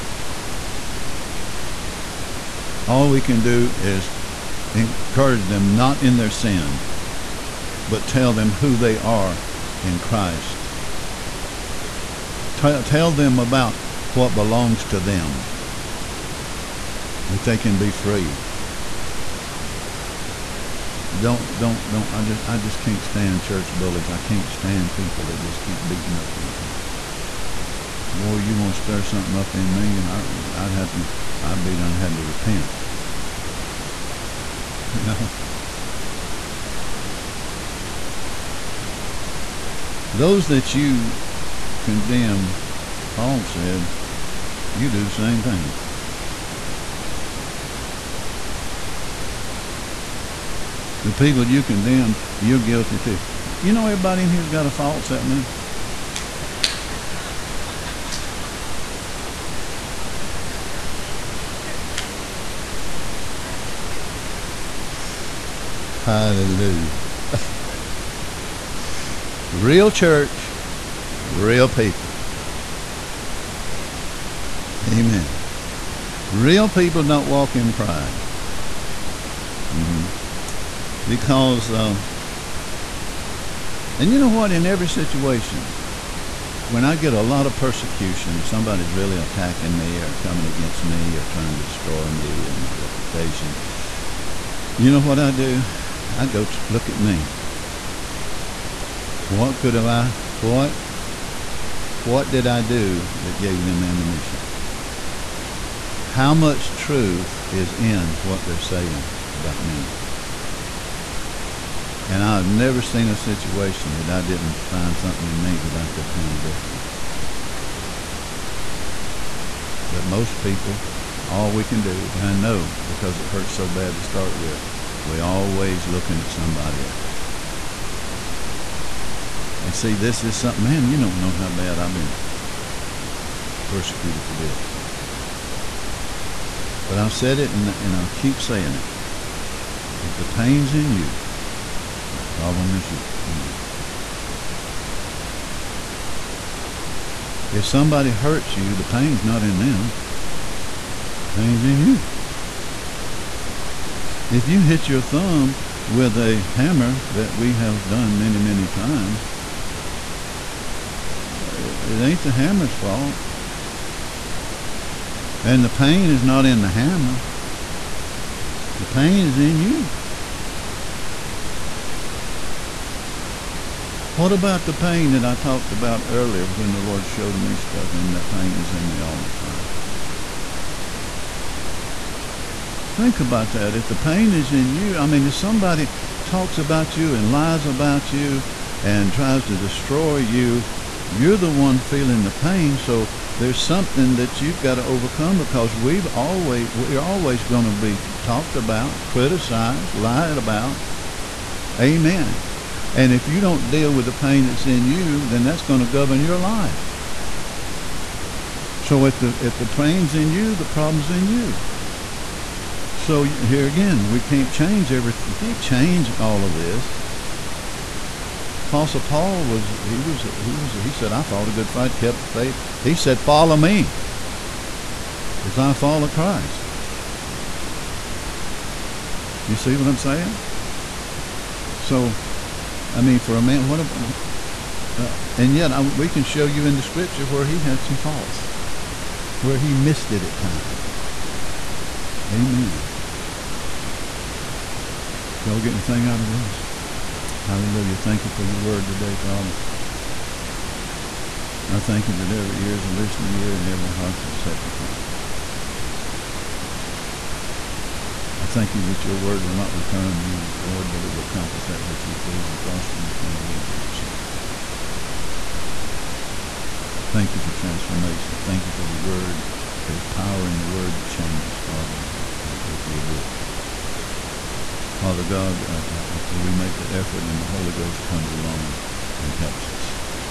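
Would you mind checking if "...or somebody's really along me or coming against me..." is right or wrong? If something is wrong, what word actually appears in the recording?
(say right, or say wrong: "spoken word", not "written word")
wrong: "attacking", not "along".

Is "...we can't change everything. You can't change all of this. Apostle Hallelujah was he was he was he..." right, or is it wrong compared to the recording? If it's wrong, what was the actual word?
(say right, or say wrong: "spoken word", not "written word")
wrong: "Paul", not "Hallelujah".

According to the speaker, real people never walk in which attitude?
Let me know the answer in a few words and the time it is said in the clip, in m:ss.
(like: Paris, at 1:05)
pride, at 1:17.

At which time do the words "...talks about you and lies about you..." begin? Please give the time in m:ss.
3:06.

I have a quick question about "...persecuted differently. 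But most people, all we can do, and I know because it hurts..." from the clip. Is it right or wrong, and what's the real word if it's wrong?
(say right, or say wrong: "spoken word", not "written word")
wrong: "handled", not "persecuted".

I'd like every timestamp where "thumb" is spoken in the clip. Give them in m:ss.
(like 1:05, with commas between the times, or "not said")
2:35.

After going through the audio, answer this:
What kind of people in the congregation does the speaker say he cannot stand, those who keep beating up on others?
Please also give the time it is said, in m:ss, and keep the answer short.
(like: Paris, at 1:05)
church bullies, at 0:23.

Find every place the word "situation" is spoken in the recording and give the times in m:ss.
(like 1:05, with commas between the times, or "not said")
1:24, 1:53.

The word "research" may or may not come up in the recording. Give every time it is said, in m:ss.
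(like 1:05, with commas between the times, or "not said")
not said.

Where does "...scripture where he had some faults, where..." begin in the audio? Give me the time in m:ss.
3:56.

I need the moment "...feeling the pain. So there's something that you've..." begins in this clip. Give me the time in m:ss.
3:11.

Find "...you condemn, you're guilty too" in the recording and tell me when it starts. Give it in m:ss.
0:51.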